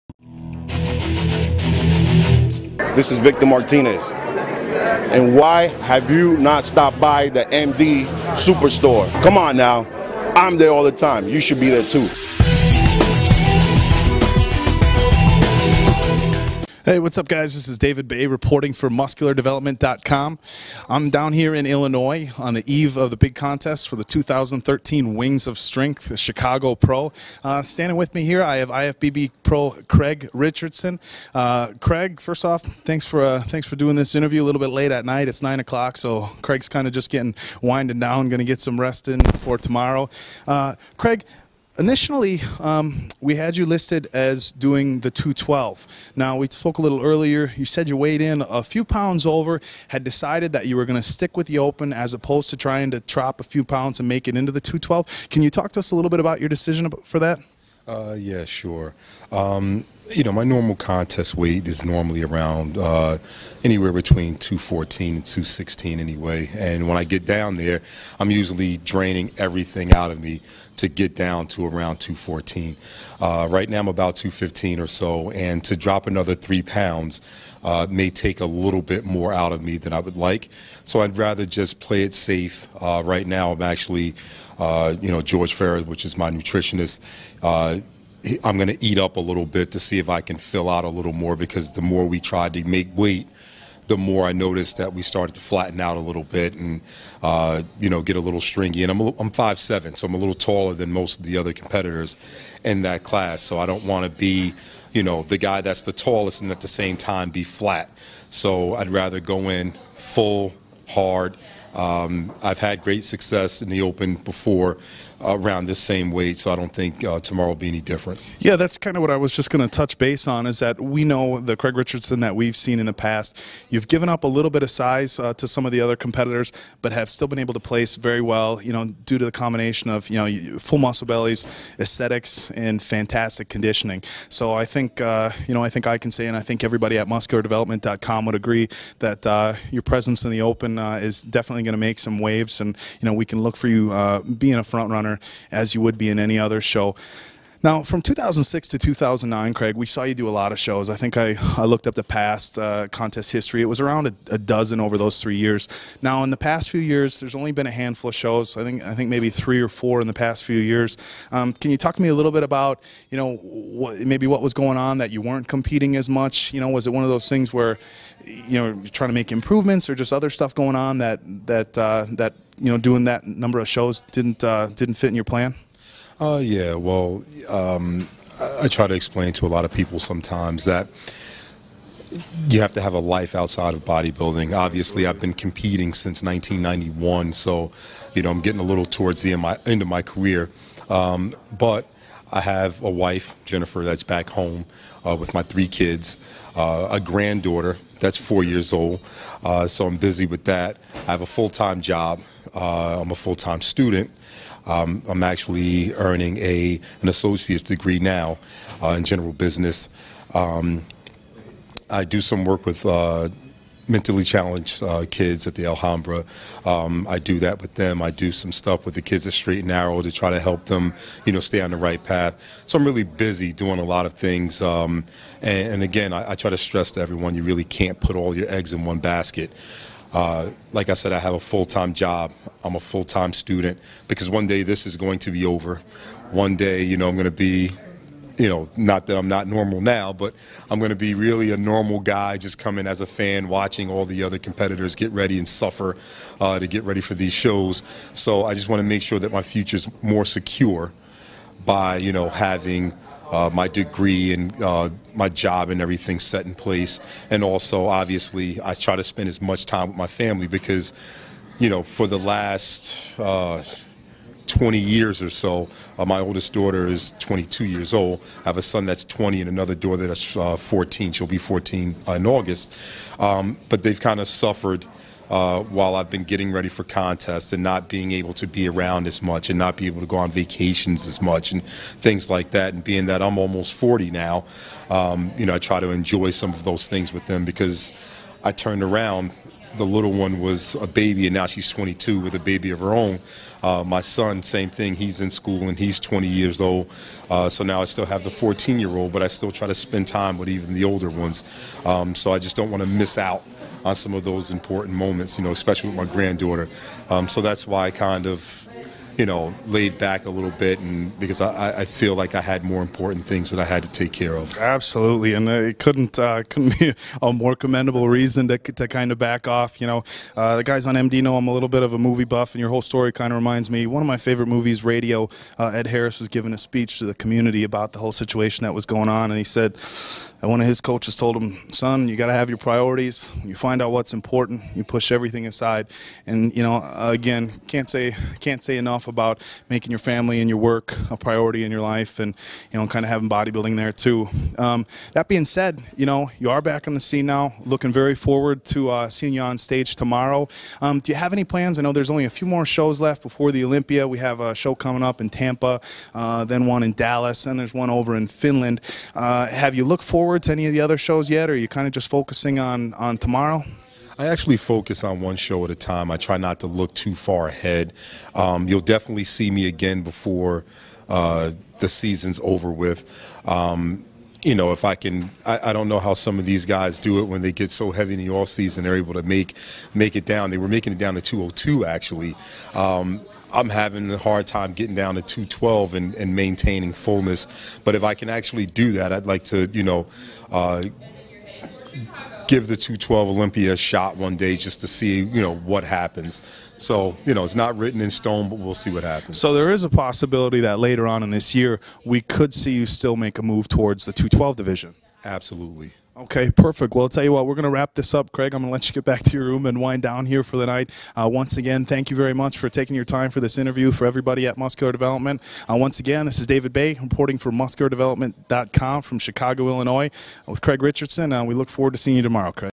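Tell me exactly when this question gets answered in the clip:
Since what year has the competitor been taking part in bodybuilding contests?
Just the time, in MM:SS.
03:06.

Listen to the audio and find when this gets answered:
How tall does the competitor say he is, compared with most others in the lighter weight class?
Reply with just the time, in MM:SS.
01:39.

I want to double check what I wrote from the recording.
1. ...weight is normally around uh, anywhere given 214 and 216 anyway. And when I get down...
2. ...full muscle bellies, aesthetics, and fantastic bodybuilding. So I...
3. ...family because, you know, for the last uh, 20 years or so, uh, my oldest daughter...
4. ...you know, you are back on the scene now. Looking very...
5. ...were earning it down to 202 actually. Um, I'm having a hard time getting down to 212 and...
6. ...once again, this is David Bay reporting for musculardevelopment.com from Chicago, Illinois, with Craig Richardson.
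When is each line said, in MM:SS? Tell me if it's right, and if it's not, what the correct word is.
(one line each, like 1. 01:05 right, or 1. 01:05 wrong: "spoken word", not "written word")
1. 01:01 wrong: "between", not "given"
2. 02:10 wrong: "conditioning", not "bodybuilding"
3. 04:20 right
4. 05:45 right
5. 06:20 wrong: "making", not "earning"
6. 06:55 right.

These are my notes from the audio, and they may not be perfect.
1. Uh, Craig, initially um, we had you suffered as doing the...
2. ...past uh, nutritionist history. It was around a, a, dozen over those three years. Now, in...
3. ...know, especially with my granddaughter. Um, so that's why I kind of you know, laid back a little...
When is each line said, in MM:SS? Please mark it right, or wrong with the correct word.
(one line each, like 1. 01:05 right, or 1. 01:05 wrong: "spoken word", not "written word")
1. 00:40 wrong: "listed", not "suffered"
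2. 02:32 wrong: "contest", not "nutritionist"
3. 05:05 right.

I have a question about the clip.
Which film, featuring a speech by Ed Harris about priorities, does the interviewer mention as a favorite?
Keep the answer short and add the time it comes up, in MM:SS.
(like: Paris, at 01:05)
Radio, at 05:24.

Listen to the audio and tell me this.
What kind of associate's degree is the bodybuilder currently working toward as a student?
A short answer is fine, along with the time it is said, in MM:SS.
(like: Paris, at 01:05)
General business, at 03:29.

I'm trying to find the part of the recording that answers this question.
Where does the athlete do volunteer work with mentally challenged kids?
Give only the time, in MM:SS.
03:35.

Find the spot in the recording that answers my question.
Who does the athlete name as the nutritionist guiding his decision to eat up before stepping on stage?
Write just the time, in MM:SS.
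01:25.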